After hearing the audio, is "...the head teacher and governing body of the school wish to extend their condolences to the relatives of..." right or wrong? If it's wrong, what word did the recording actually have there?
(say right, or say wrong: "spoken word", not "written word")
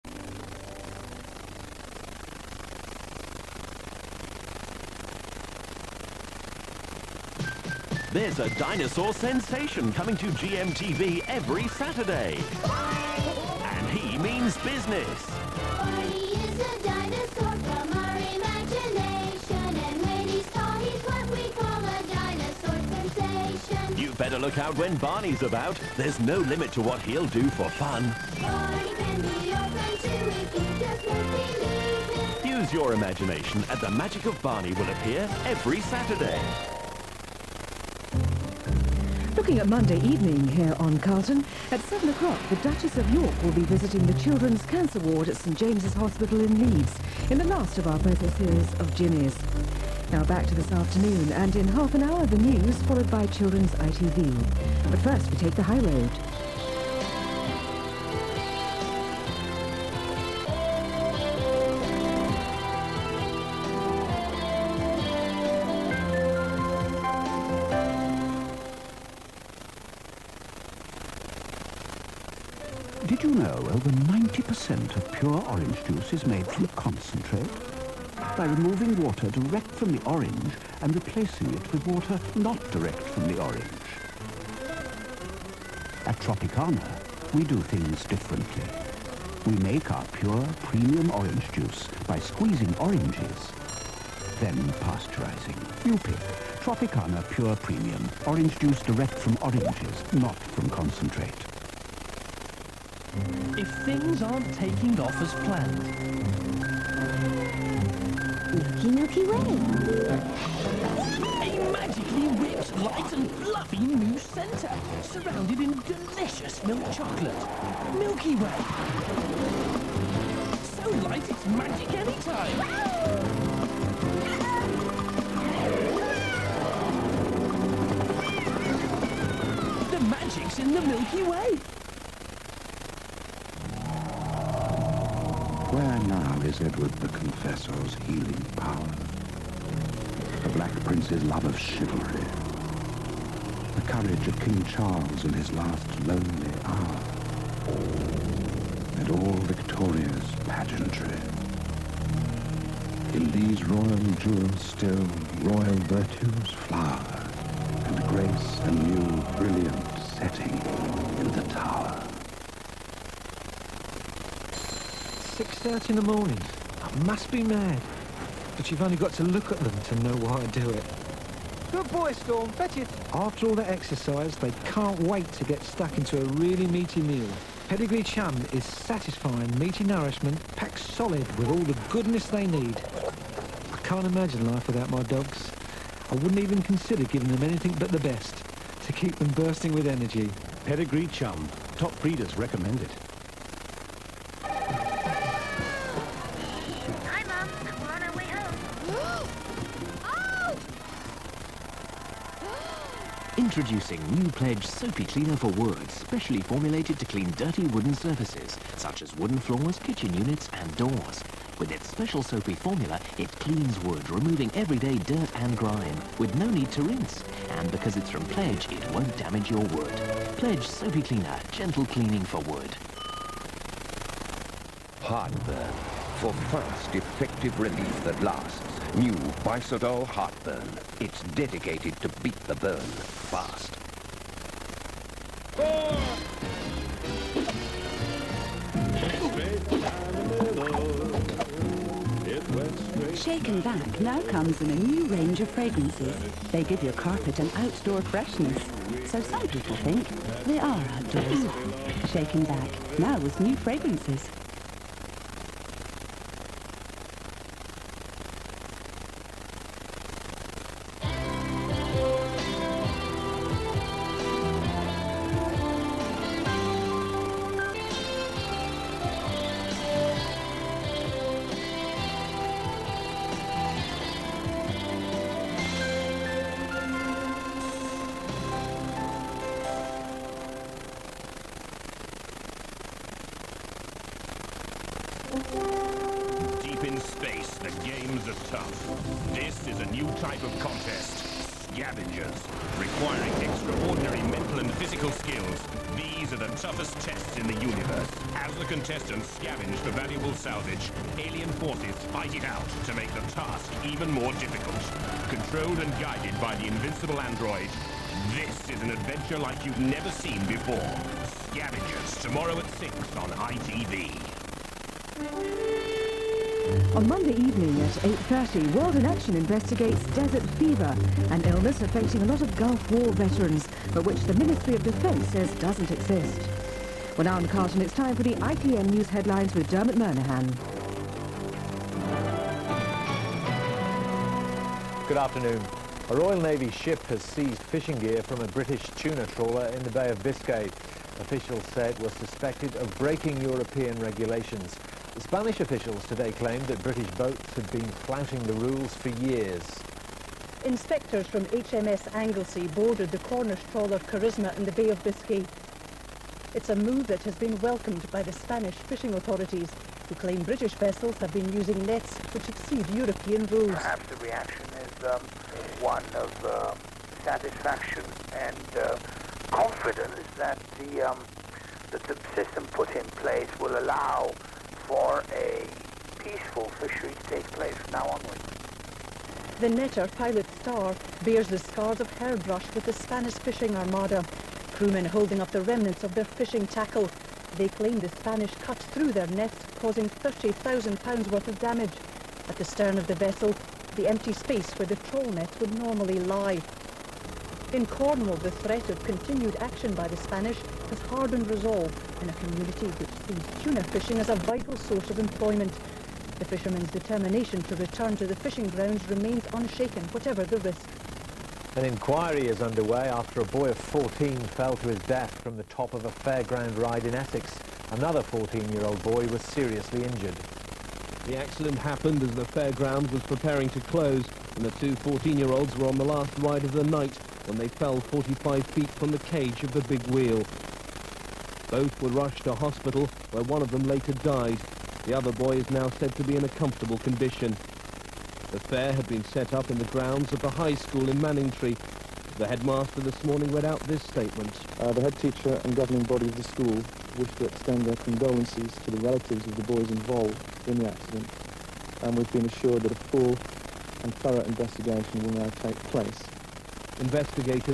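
right.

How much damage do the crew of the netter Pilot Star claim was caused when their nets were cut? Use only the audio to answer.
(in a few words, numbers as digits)
£30,000.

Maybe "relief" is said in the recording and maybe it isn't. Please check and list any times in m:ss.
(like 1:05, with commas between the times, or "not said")
3:47.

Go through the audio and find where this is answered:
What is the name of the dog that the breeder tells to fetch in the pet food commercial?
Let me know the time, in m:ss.
2:52.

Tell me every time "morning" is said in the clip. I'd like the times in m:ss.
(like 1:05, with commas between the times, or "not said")
2:46, 7:23.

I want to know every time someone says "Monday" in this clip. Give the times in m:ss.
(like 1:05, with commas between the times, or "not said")
0:39, 5:17.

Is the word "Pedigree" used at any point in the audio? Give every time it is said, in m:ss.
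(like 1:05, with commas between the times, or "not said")
2:57, 3:10.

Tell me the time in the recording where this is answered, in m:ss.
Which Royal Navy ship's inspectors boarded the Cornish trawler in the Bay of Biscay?
5:51.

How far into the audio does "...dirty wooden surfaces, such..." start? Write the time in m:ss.
3:27.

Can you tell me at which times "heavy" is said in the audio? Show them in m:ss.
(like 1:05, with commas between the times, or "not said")
not said.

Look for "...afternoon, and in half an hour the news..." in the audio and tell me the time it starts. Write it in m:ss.
0:50.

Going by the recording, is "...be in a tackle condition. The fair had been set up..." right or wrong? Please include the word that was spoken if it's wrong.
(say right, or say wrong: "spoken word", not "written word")
wrong: "comfortable", not "tackle".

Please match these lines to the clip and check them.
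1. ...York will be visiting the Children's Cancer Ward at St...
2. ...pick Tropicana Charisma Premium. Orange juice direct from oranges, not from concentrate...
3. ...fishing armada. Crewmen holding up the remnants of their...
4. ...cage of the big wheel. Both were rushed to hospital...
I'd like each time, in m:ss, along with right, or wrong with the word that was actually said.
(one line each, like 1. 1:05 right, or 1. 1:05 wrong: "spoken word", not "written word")
1. 0:43 right
2. 1:35 wrong: "Pure", not "Charisma"
3. 6:23 right
4. 7:09 right.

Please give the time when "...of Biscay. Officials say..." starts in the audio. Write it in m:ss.
5:40.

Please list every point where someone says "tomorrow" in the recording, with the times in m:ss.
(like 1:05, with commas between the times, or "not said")
5:12.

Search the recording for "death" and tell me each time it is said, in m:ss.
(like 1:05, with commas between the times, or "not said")
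6:55.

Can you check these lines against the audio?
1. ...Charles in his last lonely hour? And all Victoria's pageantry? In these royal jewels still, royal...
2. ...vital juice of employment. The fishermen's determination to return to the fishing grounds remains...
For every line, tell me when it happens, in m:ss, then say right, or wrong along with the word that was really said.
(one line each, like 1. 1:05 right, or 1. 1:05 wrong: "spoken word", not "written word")
1. 2:24 right
2. 6:44 wrong: "source", not "juice".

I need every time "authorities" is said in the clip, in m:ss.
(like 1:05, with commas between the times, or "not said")
5:59.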